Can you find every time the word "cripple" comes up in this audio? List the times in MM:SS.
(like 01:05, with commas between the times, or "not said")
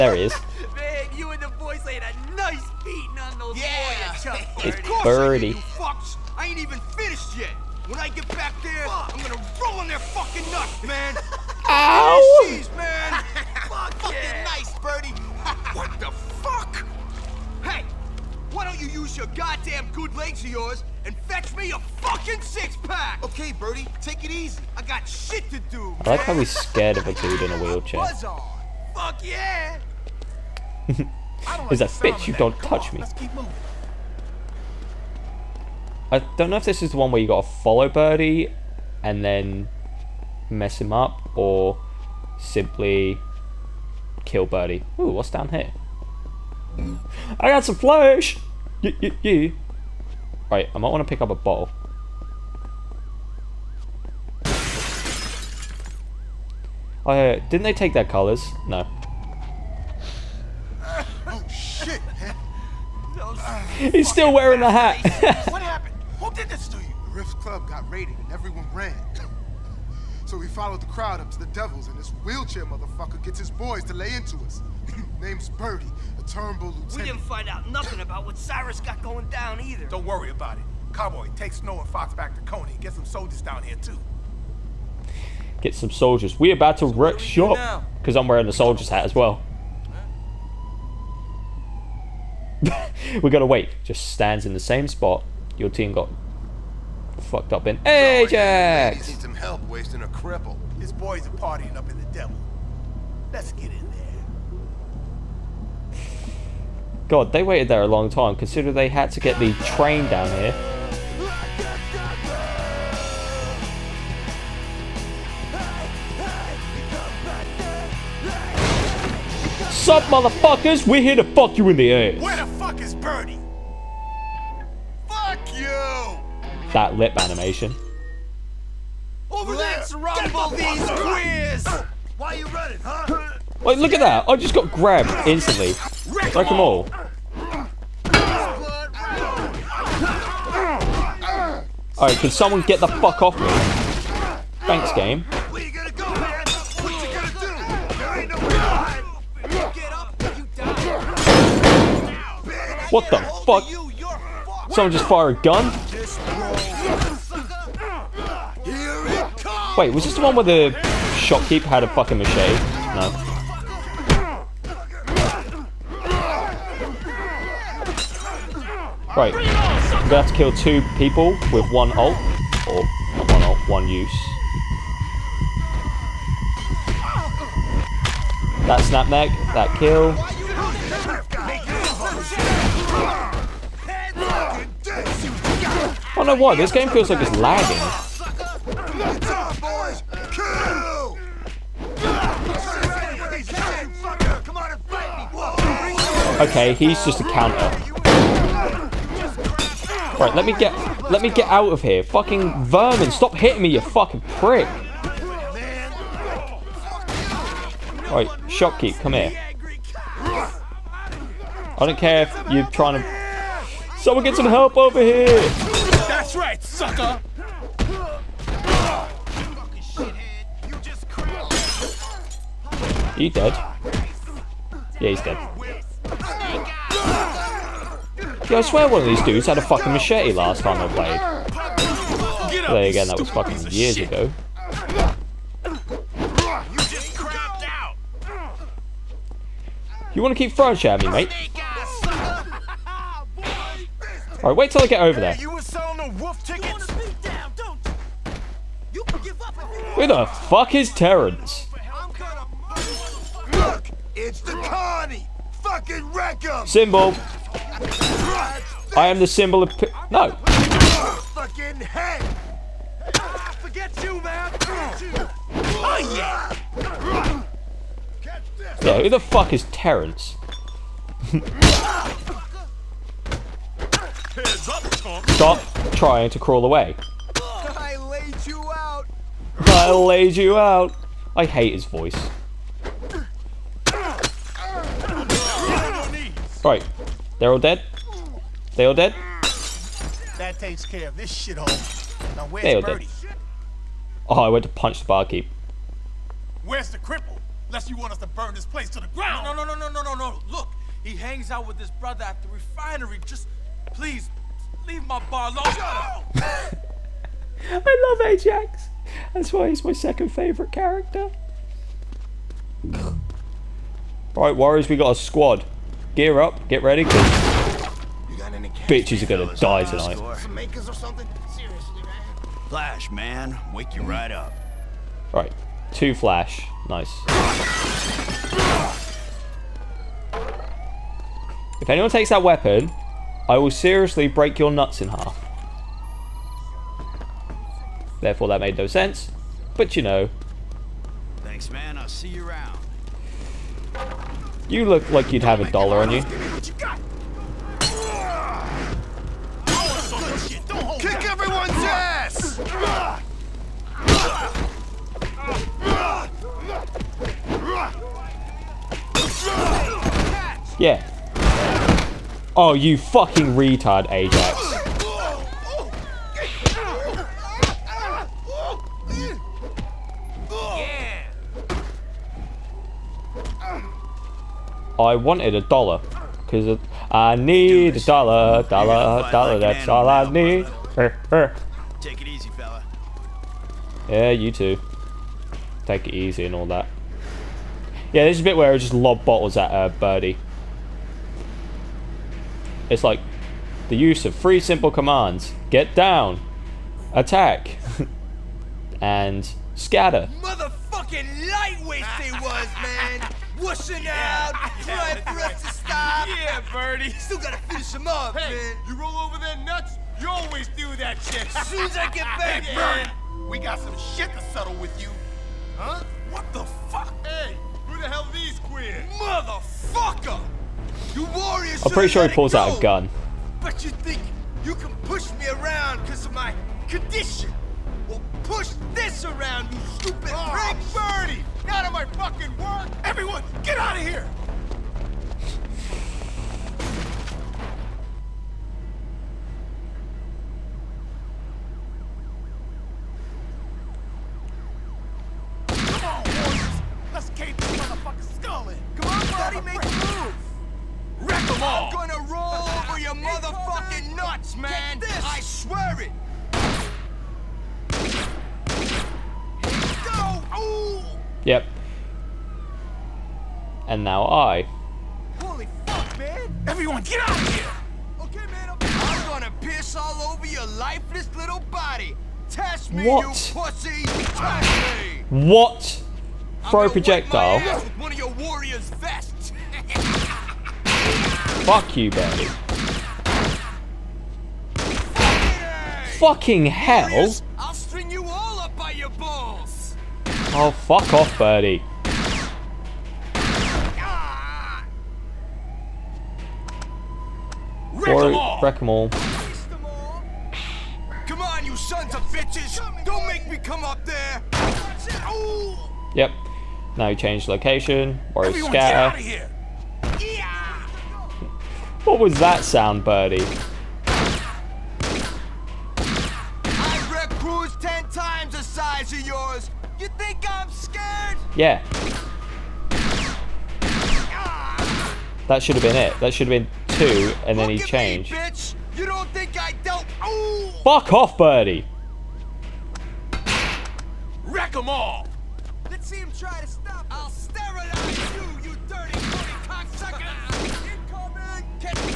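01:40, 04:56.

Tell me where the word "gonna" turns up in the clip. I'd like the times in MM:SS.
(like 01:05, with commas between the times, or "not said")
00:09, 02:49.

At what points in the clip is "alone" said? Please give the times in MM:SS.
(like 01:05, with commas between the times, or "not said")
05:05.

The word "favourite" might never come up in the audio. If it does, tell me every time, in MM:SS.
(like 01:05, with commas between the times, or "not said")
05:10.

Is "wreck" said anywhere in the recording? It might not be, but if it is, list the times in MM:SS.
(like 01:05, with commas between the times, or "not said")
01:26, 04:16, 08:18.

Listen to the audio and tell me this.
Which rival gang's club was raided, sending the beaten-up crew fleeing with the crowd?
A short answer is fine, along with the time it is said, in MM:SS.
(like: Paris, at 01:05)
The Riffs, at 01:06.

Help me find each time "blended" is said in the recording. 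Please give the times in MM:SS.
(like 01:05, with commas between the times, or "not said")
not said.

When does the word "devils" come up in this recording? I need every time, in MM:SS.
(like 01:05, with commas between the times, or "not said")
01:11, 01:42.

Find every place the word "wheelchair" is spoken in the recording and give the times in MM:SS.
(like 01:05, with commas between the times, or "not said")
00:27, 01:12.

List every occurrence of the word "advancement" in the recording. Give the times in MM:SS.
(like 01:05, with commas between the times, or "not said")
not said.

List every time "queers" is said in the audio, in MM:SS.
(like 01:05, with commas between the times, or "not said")
02:10, 06:58.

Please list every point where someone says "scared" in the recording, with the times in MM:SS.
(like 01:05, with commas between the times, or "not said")
00:26.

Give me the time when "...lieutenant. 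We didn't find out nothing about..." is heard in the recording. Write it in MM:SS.
01:16.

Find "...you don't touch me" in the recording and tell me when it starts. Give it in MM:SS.
00:32.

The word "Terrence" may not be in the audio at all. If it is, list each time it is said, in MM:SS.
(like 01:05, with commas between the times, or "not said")
04:10, 04:29.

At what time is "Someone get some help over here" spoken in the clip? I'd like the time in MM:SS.
03:33.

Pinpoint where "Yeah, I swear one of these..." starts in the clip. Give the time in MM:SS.
03:48.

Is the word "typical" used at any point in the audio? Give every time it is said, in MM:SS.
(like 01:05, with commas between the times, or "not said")
not said.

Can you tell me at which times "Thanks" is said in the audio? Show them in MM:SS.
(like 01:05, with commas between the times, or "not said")
02:24, 05:41.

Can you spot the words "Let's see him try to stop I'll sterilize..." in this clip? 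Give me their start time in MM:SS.
08:55.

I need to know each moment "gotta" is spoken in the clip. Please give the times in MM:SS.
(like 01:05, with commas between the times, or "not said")
00:37, 01:33, 06:47.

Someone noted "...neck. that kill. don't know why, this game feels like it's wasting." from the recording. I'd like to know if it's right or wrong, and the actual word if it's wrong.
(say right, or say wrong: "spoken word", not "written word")
wrong: "lagging", not "wasting".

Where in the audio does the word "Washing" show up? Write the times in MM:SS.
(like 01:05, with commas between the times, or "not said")
06:43.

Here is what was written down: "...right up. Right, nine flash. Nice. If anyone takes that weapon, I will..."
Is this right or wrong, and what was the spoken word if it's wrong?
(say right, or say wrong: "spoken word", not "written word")
wrong: "two", not "nine".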